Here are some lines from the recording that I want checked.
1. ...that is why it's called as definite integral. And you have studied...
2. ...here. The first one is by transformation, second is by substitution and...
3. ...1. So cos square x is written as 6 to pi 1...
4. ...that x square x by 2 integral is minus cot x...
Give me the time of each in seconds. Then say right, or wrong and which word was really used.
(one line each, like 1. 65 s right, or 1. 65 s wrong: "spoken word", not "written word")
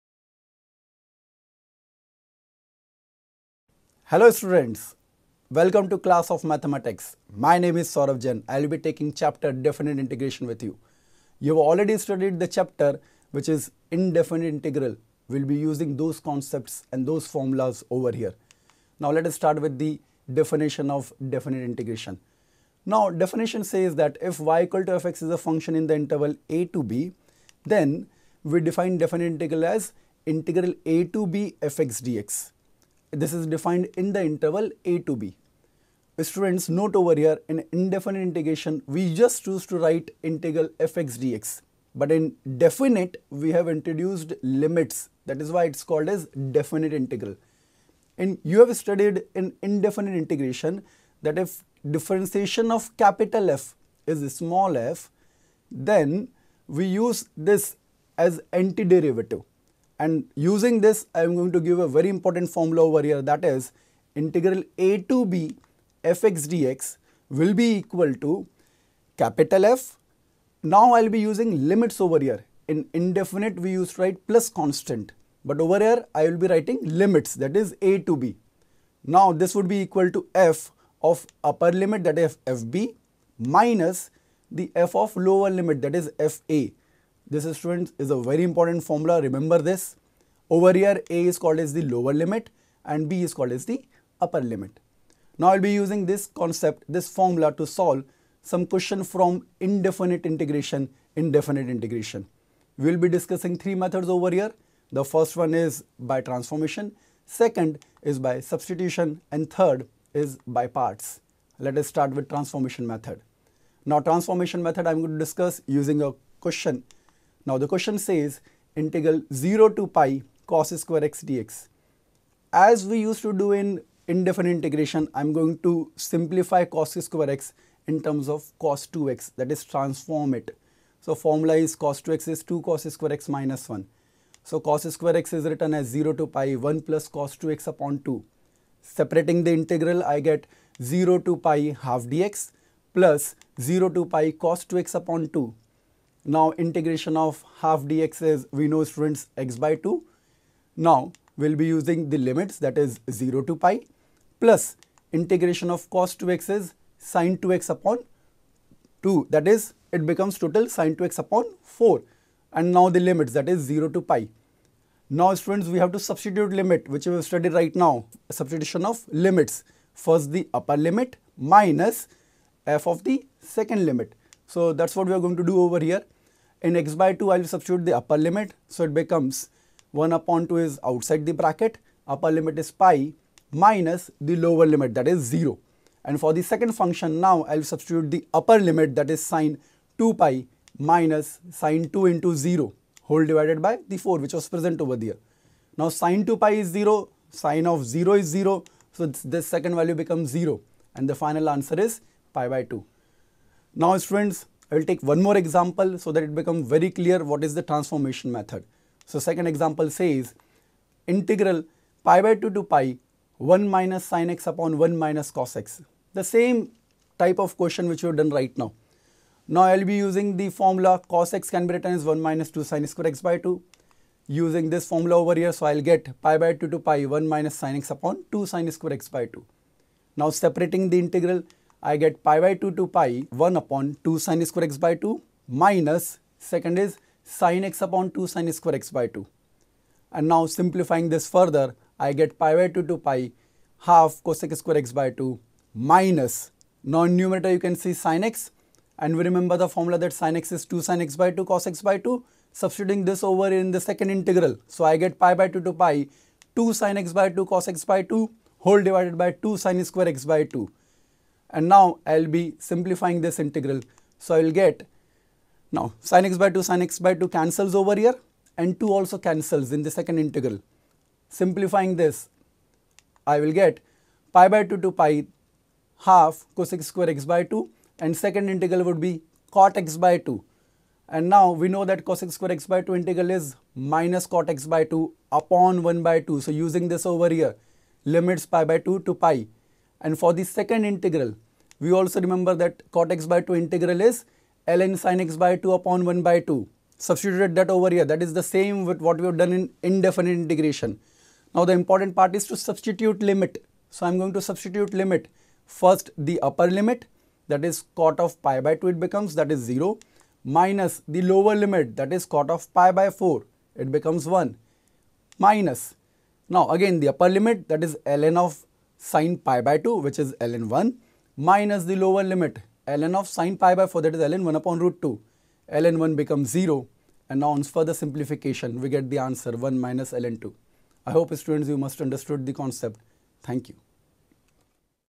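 1. 45 s right
2. 104 s right
3. 133 s wrong: "0", not "6"
4. 281 s right.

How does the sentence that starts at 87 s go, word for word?
This students is a very important formula.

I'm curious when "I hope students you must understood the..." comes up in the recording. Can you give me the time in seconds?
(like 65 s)
331 s.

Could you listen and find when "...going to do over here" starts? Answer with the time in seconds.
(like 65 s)
175 s.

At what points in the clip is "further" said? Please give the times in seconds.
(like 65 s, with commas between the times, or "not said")
241 s, 327 s.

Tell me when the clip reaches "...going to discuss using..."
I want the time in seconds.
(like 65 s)
114 s.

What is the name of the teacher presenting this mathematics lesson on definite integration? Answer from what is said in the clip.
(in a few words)
Saurav Jain.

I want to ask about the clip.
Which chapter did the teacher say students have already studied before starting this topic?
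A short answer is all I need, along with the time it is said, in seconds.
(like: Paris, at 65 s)
indefinite integral, at 13 s.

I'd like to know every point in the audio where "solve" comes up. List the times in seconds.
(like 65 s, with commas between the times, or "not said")
97 s.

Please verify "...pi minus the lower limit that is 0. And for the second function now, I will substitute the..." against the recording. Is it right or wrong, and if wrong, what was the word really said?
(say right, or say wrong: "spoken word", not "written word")
right.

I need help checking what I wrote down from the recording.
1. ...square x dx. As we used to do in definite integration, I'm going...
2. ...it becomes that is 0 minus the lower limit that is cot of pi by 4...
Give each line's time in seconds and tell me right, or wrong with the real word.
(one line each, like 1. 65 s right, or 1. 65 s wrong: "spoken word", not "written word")
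1. 120 s wrong: "indefinite", not "definite"
2. 308 s right.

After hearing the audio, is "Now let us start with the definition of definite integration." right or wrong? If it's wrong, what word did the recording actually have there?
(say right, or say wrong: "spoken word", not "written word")
right.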